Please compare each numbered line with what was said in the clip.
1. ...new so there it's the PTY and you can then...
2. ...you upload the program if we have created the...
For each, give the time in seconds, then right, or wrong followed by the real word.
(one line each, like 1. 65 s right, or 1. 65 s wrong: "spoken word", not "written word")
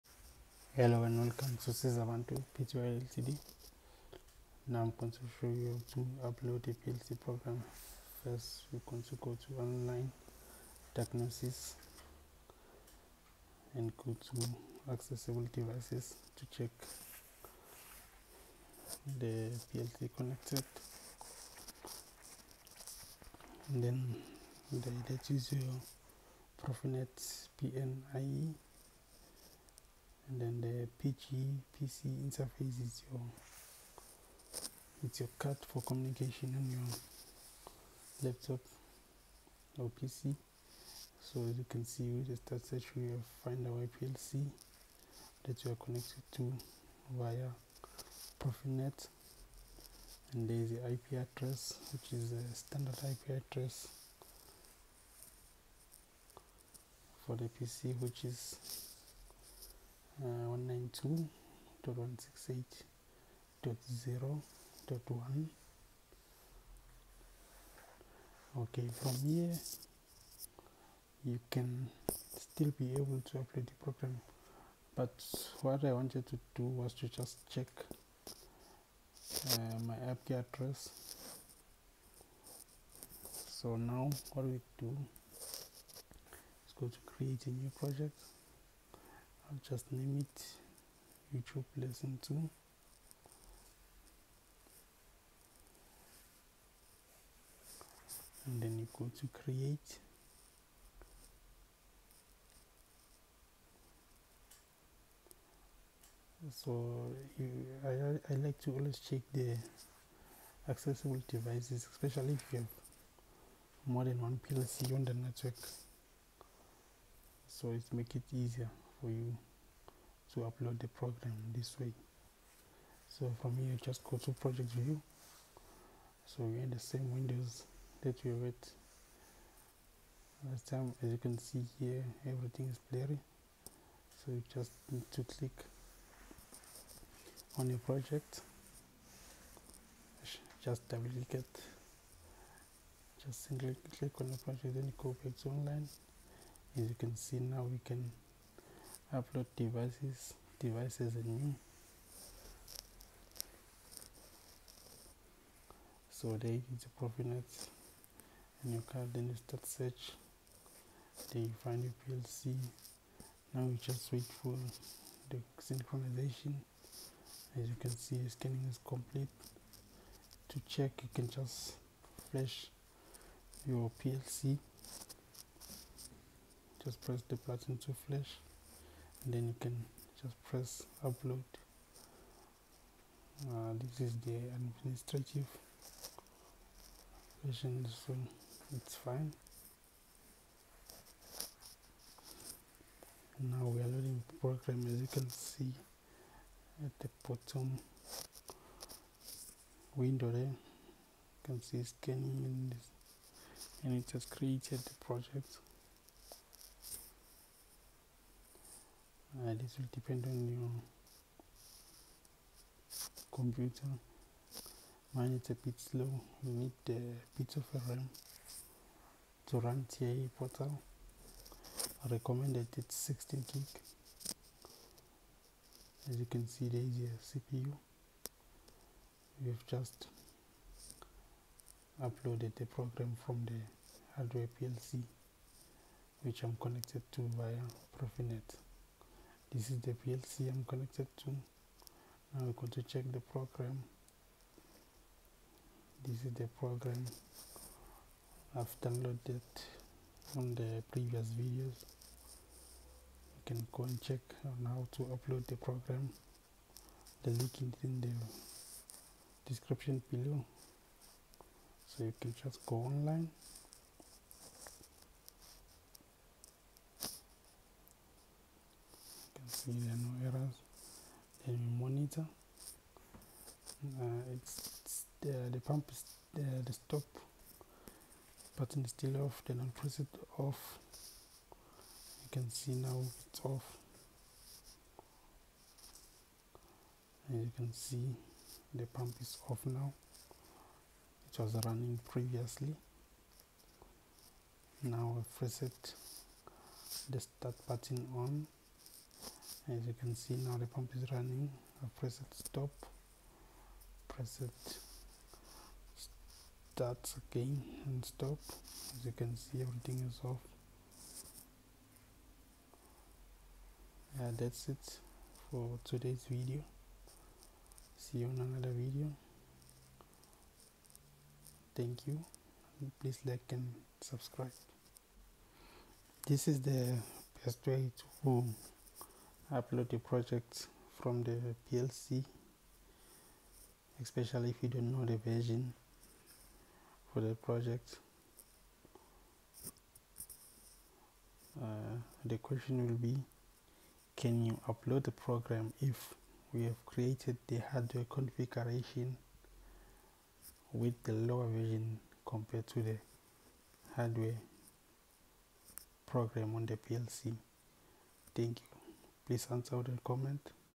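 1. 151 s wrong: "Profinet", not "PTY"
2. 344 s right.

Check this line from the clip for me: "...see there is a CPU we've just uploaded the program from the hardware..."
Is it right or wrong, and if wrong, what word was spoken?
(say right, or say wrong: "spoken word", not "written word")
right.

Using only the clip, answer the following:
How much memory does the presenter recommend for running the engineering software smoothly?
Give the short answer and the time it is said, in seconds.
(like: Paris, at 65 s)
16 gig, at 222 s.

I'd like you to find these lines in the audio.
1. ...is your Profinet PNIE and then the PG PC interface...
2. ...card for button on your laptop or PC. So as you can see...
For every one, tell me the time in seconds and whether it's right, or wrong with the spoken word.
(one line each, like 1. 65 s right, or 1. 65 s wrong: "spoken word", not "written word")
1. 25 s right
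2. 35 s wrong: "communication", not "button".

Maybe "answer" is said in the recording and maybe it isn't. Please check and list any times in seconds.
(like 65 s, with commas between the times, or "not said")
359 s.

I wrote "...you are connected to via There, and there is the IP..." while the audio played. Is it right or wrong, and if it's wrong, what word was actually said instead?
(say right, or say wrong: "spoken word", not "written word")
wrong: "Profinet", not "There".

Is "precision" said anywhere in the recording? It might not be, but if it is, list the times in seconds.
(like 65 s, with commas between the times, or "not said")
not said.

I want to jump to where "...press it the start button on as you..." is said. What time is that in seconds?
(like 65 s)
295 s.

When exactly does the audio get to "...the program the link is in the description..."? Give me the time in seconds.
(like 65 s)
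255 s.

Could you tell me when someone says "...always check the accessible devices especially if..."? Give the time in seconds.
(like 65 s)
108 s.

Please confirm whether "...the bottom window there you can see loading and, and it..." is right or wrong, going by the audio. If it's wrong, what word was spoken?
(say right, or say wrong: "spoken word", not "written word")
wrong: "scanning", not "loading".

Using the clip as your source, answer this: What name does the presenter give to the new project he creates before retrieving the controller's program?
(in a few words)
YouTube lesson 2.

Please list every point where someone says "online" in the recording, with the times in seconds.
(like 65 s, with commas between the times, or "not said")
9 s, 145 s, 262 s.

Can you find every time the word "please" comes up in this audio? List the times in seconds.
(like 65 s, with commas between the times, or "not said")
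322 s, 359 s.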